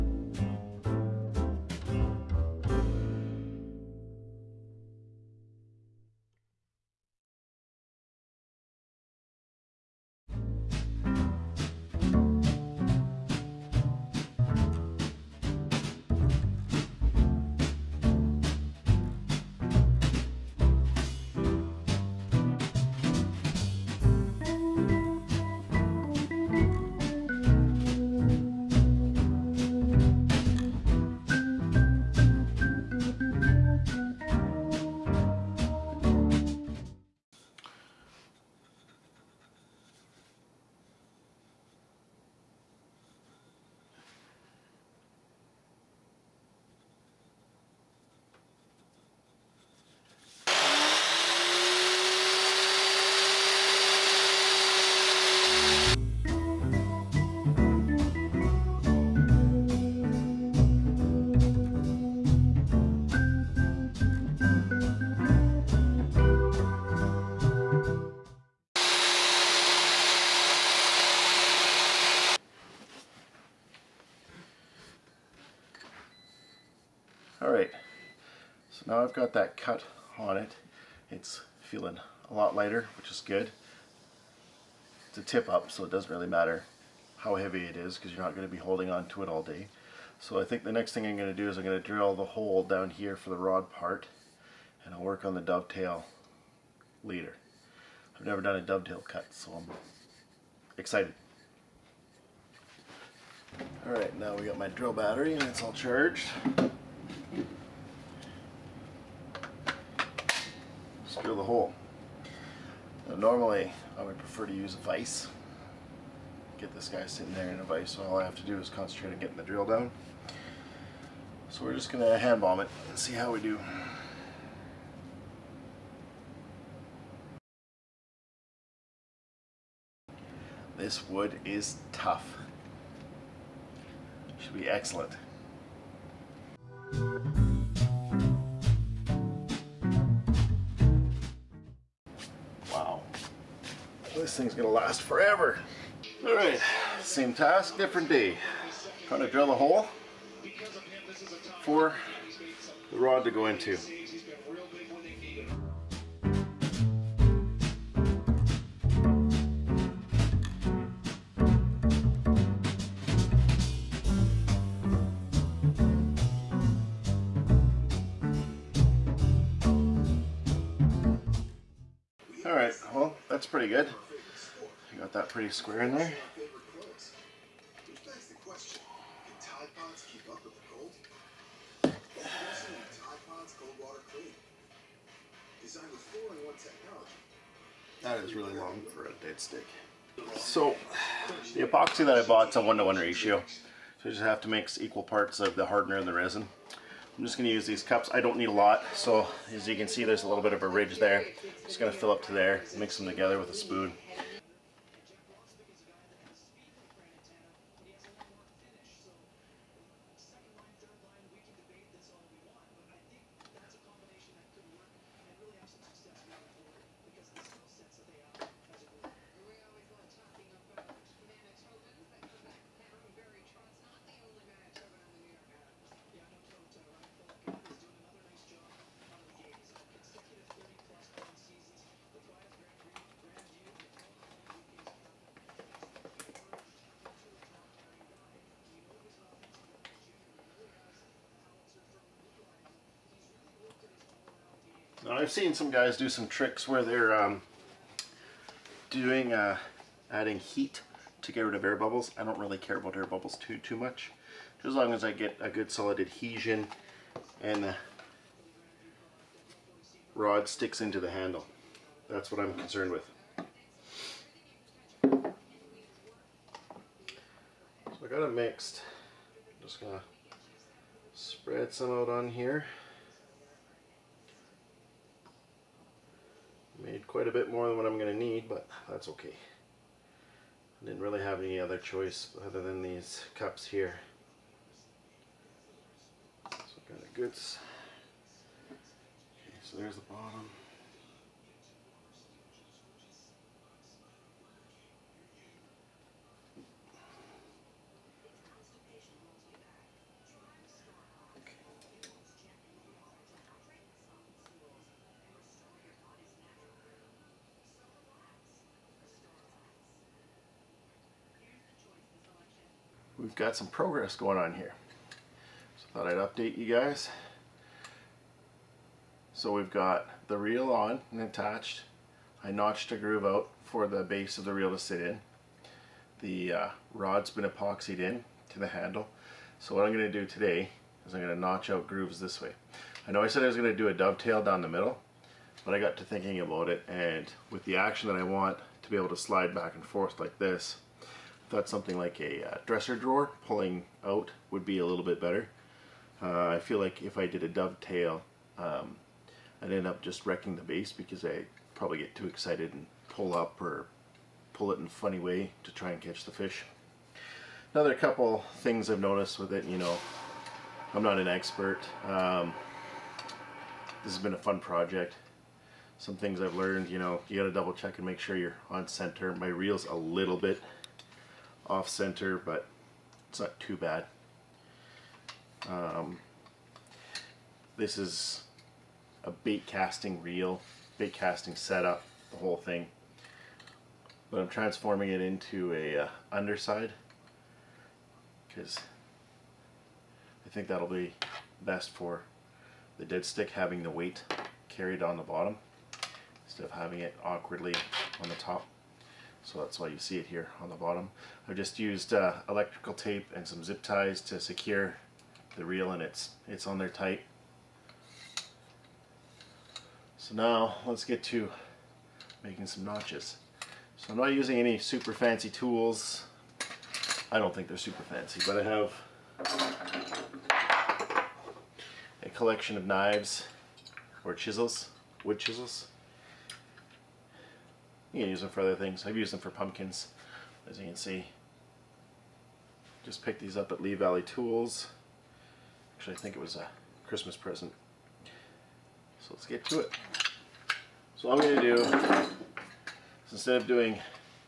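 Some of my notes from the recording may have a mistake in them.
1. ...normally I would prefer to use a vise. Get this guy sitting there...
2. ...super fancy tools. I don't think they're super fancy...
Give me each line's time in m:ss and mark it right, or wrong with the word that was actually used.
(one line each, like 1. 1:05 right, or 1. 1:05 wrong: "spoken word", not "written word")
1. 1:53 right
2. 6:54 right.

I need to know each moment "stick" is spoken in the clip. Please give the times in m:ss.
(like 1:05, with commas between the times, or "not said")
3:09, 4:20, 6:33.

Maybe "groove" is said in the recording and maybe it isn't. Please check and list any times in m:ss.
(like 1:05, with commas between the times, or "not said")
5:22, 5:31.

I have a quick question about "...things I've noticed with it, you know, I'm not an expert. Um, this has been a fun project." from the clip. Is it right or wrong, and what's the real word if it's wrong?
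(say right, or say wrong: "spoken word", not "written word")
right.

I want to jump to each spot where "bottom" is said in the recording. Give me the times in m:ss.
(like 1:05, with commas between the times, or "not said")
4:50, 6:35, 6:40.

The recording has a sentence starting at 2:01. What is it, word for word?
So we're just going to hand bomb it and see how we do.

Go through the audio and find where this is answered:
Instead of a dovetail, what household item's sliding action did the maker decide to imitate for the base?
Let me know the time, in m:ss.
5:42.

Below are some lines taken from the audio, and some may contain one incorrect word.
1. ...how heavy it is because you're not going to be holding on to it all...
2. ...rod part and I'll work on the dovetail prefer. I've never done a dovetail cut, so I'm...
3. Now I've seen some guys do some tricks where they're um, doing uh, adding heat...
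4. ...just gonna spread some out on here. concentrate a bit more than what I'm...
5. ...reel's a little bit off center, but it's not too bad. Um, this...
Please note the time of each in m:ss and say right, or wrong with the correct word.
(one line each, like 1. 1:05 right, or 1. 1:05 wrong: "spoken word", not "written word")
1. 1:27 right
2. 1:33 wrong: "later", not "prefer"
3. 4:05 right
4. 4:29 wrong: "quite", not "concentrate"
5. 6:09 right.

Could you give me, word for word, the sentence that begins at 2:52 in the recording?
All right, well, that's pretty good that pretty square in there.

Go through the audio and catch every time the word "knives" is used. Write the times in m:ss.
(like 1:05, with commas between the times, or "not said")
7:02.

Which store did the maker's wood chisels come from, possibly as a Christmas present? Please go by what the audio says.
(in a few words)
Lee Valley Tools.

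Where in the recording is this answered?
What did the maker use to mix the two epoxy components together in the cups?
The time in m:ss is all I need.
3:23.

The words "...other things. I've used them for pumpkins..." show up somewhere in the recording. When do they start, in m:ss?
7:08.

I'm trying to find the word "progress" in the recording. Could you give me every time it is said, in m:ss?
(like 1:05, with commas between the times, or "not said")
5:13.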